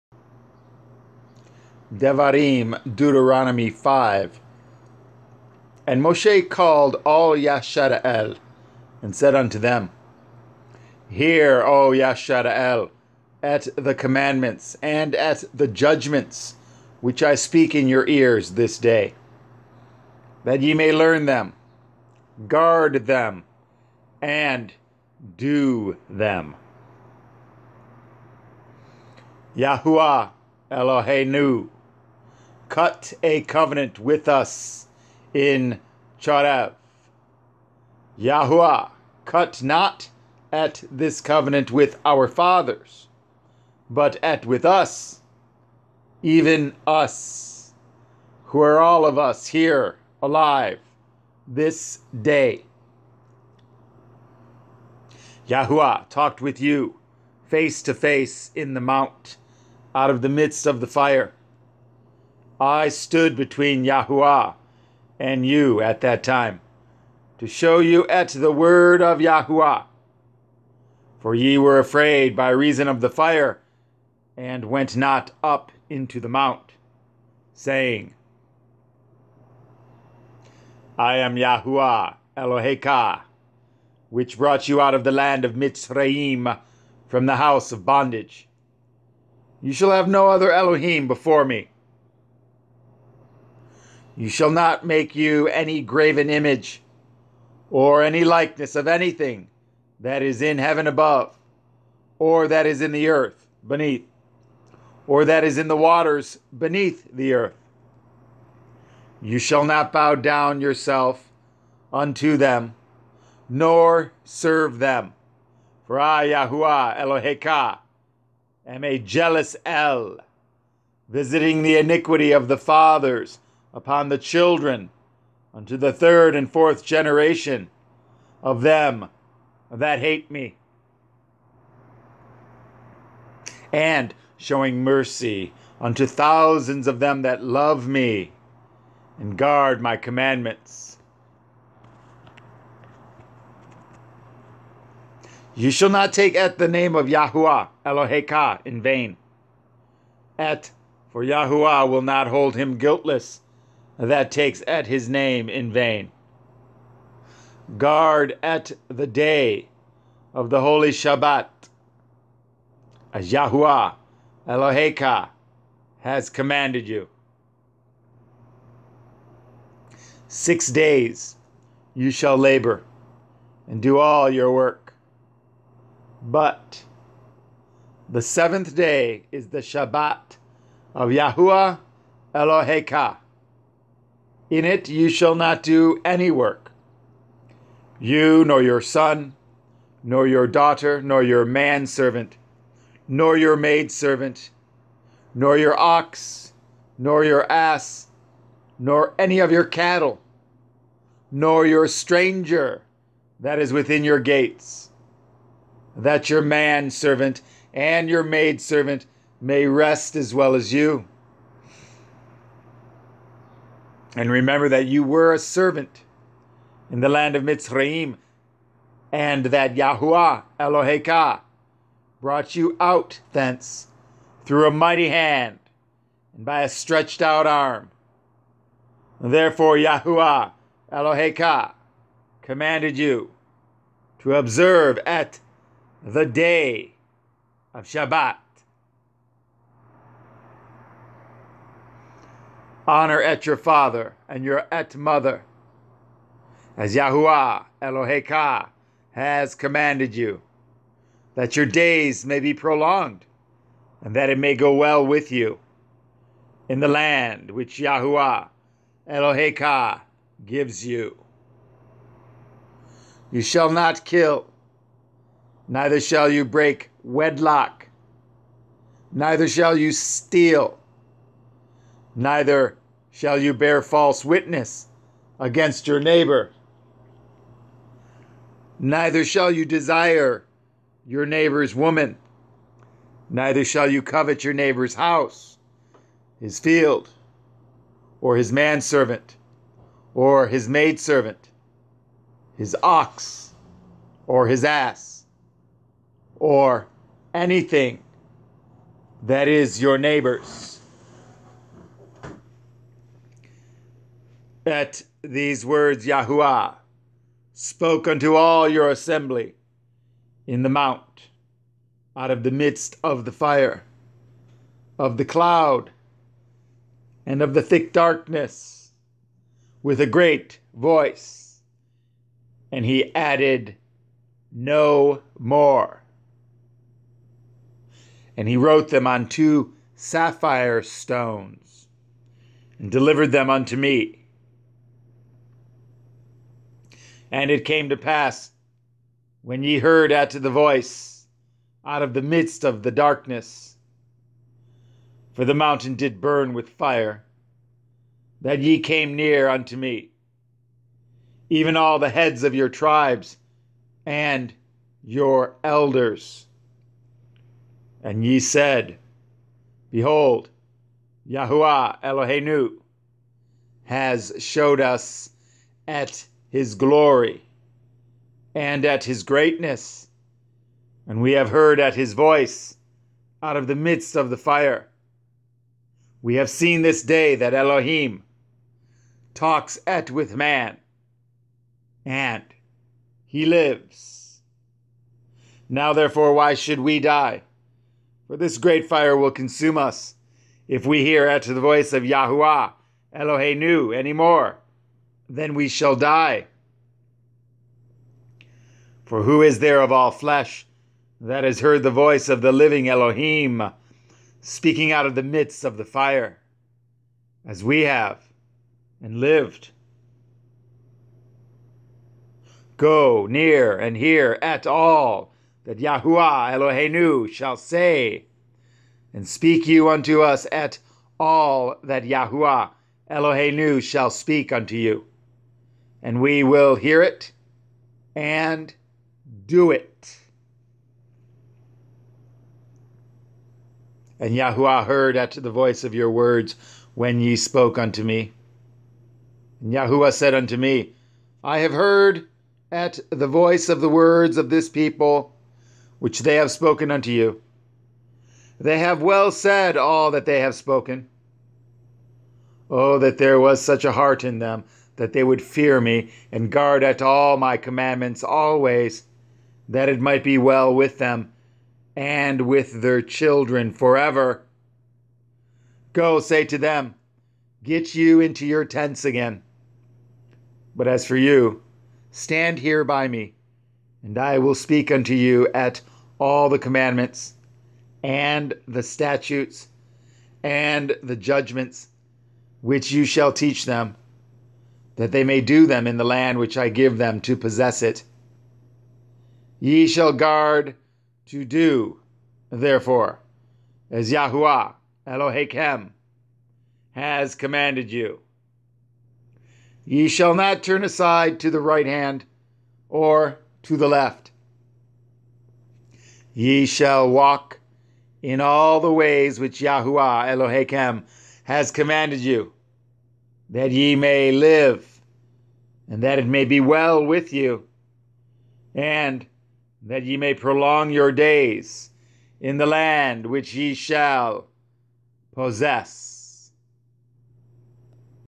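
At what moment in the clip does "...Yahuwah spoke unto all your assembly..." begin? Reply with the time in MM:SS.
05:06.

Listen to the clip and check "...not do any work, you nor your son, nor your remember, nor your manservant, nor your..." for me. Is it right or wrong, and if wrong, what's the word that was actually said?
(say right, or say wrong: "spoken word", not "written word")
wrong: "daughter", not "remember".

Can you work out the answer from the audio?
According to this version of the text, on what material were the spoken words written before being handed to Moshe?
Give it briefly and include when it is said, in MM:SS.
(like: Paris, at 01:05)
two sapphire stones, at 05:29.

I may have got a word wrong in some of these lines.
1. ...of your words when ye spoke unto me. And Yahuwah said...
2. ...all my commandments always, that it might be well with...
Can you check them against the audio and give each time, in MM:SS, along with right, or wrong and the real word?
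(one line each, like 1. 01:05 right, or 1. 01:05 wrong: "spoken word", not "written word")
1. 07:15 right
2. 07:37 right.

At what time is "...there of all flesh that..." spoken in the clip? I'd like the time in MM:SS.
06:39.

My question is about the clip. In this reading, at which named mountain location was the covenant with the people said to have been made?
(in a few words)
Chorev.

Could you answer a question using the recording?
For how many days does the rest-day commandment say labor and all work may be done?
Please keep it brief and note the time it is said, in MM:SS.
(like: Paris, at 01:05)
6, at 02:50.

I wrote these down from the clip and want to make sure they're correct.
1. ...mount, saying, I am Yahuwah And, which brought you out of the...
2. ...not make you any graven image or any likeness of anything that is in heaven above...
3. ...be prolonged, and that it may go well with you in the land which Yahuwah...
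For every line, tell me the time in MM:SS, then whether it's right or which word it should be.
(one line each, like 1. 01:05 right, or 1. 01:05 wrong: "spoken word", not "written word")
1. 01:16 wrong: "Eloheka", not "And"
2. 01:34 right
3. 04:12 right.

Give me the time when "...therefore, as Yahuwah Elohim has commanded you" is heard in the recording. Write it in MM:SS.
08:12.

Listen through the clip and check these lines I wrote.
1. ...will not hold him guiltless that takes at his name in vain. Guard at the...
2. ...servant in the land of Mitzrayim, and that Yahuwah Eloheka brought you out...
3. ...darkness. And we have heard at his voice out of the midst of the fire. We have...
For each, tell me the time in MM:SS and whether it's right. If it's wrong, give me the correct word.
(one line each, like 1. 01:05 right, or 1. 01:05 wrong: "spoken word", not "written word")
1. 02:31 right
2. 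03:35 right
3. 06:09 wrong: "greatness", not "darkness".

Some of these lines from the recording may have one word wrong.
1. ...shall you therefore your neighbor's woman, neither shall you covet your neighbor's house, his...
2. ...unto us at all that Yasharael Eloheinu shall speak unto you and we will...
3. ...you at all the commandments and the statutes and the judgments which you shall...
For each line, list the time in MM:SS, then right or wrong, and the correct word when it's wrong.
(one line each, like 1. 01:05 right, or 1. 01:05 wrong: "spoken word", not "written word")
1. 04:39 wrong: "desire", not "therefore"
2. 06:59 wrong: "Yahuwah", not "Yasharael"
3. 07:55 right.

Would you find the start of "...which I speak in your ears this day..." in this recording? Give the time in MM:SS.
00:17.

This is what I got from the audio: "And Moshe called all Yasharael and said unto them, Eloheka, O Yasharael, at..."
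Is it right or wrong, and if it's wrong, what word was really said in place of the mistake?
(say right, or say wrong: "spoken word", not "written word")
wrong: "Hear", not "Eloheka".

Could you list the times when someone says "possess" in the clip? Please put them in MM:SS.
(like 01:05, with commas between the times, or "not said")
08:07, 08:45.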